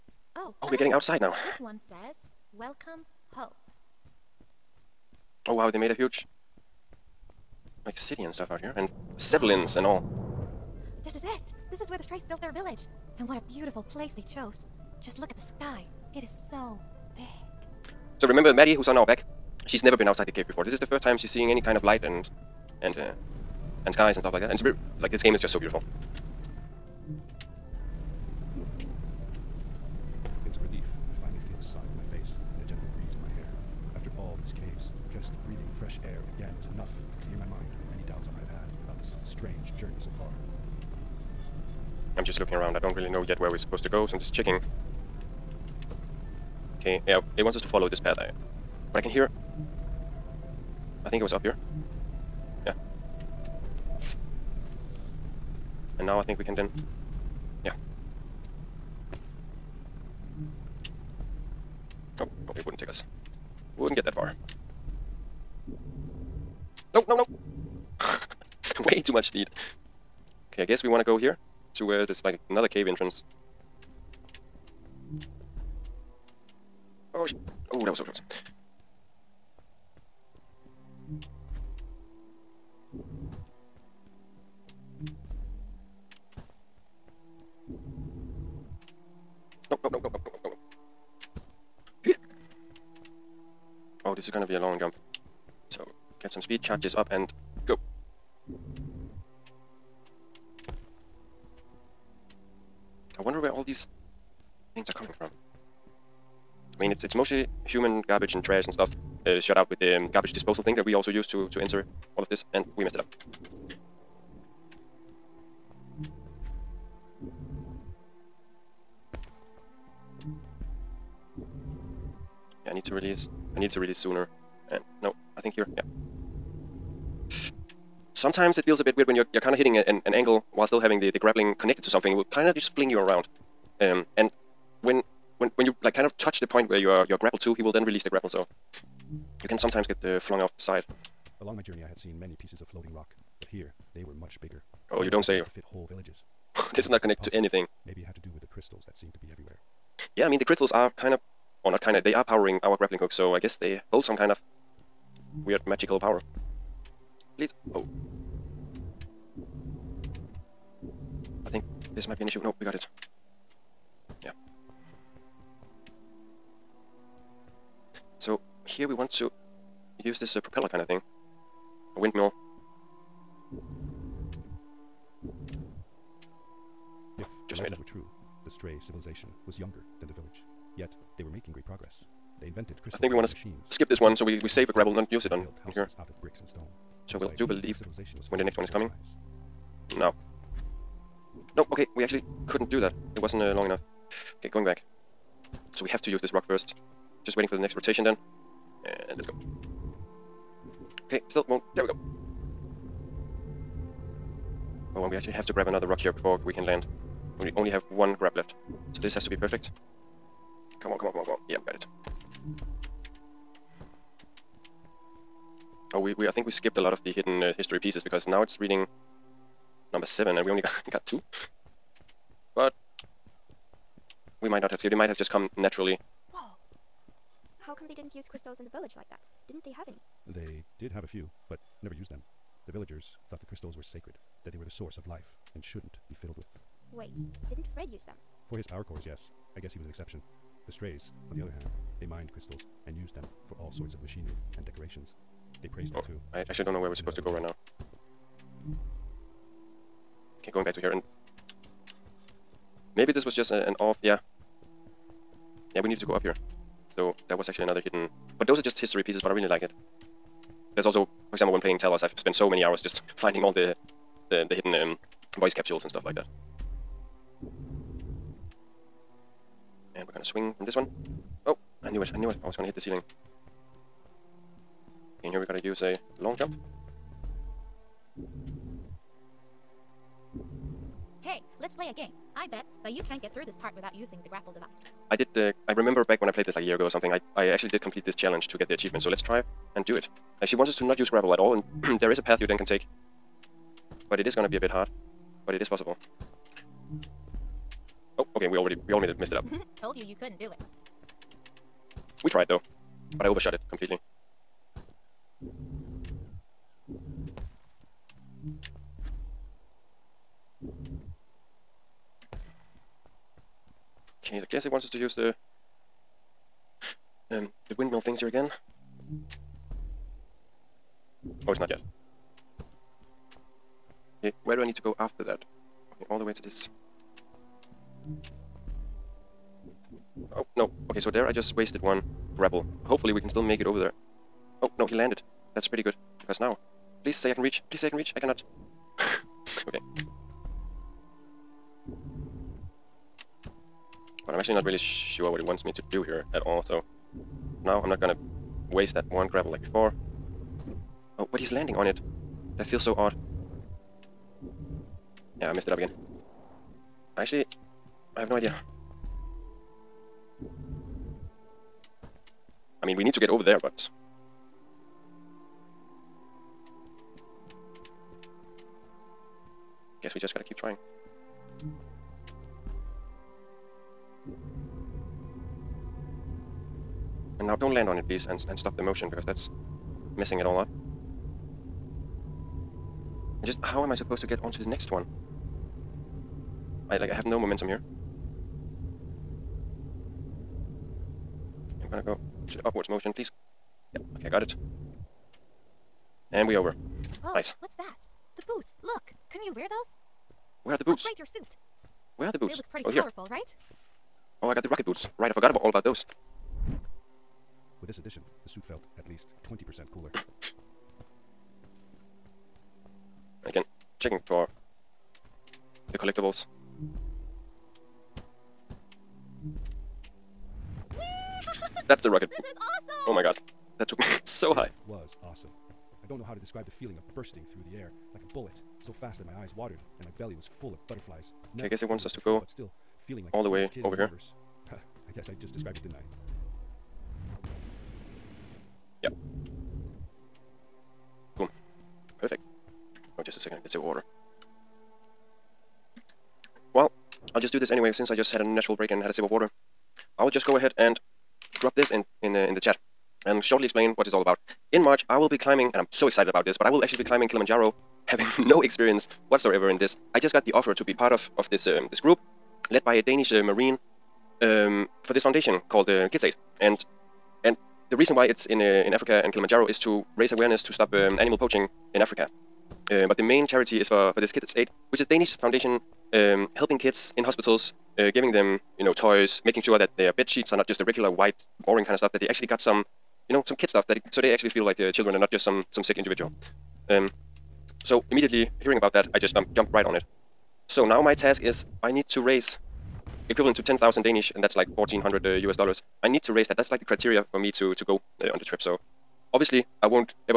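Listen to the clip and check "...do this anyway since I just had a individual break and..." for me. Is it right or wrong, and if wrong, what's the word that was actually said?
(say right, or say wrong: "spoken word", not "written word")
wrong: "natural", not "individual".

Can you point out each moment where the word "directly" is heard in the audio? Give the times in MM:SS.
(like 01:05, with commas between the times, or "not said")
not said.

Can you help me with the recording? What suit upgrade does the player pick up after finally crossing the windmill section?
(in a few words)
rocket boots.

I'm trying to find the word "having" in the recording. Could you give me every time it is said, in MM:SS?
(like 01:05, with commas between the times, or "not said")
02:10, 07:38.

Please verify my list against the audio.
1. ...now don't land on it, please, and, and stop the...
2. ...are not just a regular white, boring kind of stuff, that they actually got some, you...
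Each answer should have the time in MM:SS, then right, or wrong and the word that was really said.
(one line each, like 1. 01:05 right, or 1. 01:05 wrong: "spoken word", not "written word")
1. 06:17 right
2. 08:00 right.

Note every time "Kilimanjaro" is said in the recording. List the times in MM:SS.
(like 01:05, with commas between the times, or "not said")
07:37, 07:49.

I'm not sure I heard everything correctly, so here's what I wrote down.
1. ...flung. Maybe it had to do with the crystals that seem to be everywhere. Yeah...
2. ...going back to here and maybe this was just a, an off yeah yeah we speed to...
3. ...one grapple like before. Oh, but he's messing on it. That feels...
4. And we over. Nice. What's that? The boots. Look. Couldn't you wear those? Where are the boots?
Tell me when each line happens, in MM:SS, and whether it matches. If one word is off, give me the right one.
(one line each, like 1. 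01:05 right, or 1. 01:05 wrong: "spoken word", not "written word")
1. 02:27 wrong: "anything", not "flung"
2. 04:10 wrong: "needed", not "speed"
3. 05:49 wrong: "landing", not "messing"
4. 06:36 right.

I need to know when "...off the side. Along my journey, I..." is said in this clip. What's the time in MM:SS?
02:20.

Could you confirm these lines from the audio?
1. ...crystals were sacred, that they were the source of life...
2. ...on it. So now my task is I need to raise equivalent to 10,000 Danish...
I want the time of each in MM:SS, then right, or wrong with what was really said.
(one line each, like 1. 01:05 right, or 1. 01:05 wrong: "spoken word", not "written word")
1. 03:53 right
2. 08:09 right.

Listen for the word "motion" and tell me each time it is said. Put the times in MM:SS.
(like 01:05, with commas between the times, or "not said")
06:18, 06:32.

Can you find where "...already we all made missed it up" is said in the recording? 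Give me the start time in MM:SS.
04:58.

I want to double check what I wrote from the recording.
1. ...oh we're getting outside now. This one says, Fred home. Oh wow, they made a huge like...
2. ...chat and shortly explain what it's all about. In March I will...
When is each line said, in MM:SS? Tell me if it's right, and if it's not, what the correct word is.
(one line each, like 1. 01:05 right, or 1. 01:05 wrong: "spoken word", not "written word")
1. 00:00 wrong: "Welcome", not "Fred"
2. 07:32 right.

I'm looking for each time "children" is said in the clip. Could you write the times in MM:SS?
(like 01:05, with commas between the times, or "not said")
08:04.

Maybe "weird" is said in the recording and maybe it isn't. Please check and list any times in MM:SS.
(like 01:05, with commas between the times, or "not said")
02:08, 02:35.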